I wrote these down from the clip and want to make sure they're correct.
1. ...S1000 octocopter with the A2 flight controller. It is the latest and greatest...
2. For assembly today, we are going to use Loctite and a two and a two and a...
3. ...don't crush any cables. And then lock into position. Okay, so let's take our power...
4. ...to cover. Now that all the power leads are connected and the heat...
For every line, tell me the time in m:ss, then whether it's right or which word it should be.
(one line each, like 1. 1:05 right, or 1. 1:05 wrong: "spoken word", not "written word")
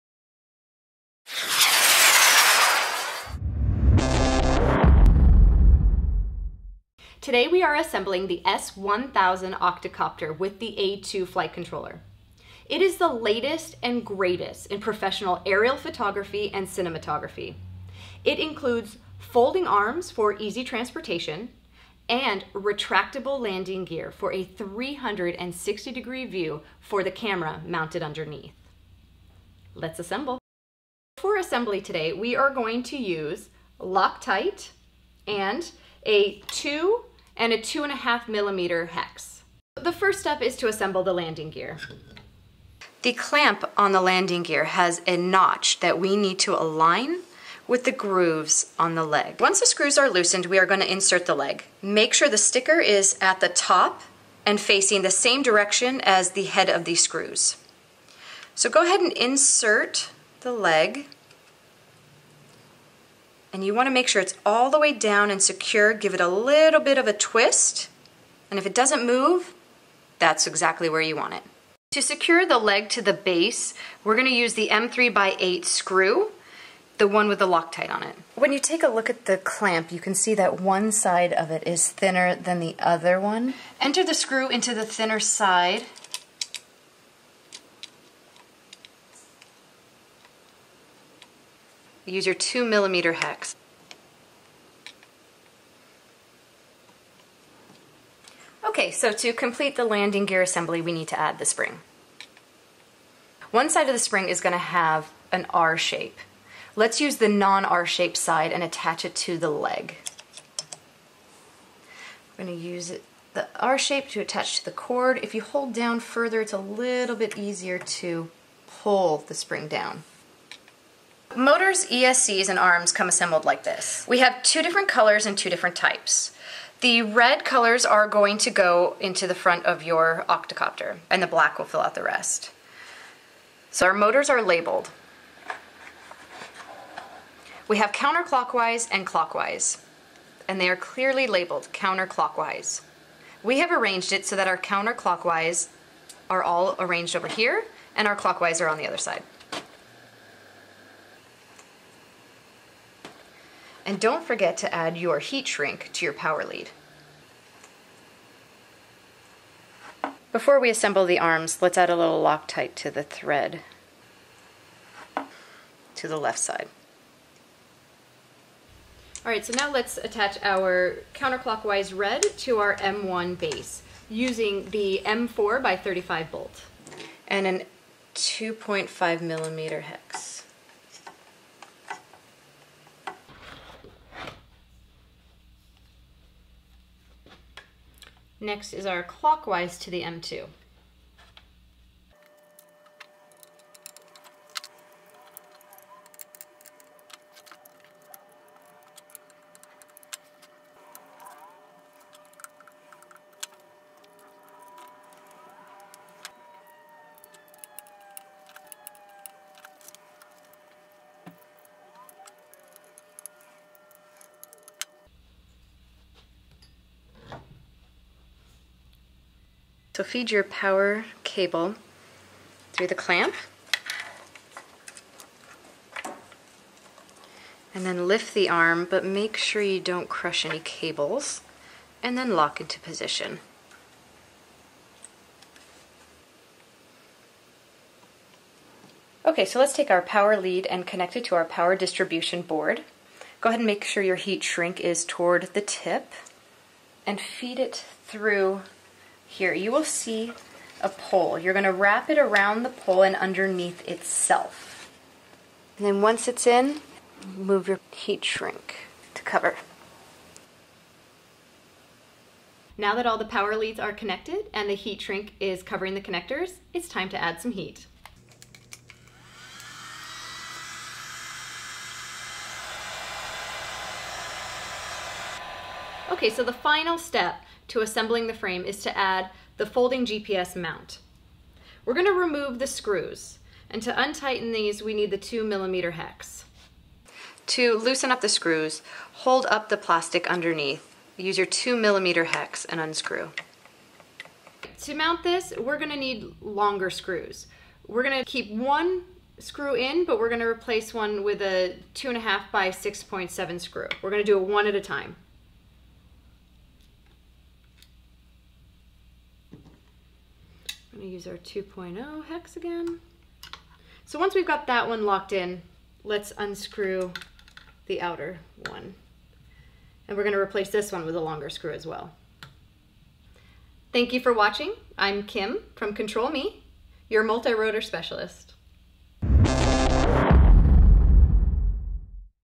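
1. 0:08 right
2. 0:31 right
3. 3:49 right
4. 4:19 right.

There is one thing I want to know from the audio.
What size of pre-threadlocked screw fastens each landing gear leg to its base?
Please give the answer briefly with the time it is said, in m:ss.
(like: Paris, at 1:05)
M3 by 8, at 1:14.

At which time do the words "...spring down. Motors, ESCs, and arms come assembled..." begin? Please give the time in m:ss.
1:59.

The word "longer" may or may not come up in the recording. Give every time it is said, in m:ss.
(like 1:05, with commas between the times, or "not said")
4:56, 5:21.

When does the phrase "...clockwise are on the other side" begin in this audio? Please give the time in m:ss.
2:28.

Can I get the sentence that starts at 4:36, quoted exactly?
Okay, so the final step to assembling the frame is to add the folding GPS mount.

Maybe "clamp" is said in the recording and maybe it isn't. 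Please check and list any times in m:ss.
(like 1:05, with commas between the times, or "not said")
0:43, 1:19, 3:42.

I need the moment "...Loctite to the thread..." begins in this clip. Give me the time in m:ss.
2:42.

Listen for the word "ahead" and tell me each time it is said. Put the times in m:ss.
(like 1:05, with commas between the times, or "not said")
0:58, 4:03.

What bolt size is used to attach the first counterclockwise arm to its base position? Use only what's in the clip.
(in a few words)
M4 by 35.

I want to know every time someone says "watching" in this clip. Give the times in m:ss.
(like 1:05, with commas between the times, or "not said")
5:24.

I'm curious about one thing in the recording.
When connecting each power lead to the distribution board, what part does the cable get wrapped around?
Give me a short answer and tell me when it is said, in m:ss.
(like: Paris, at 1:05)
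A pole, at 4:10.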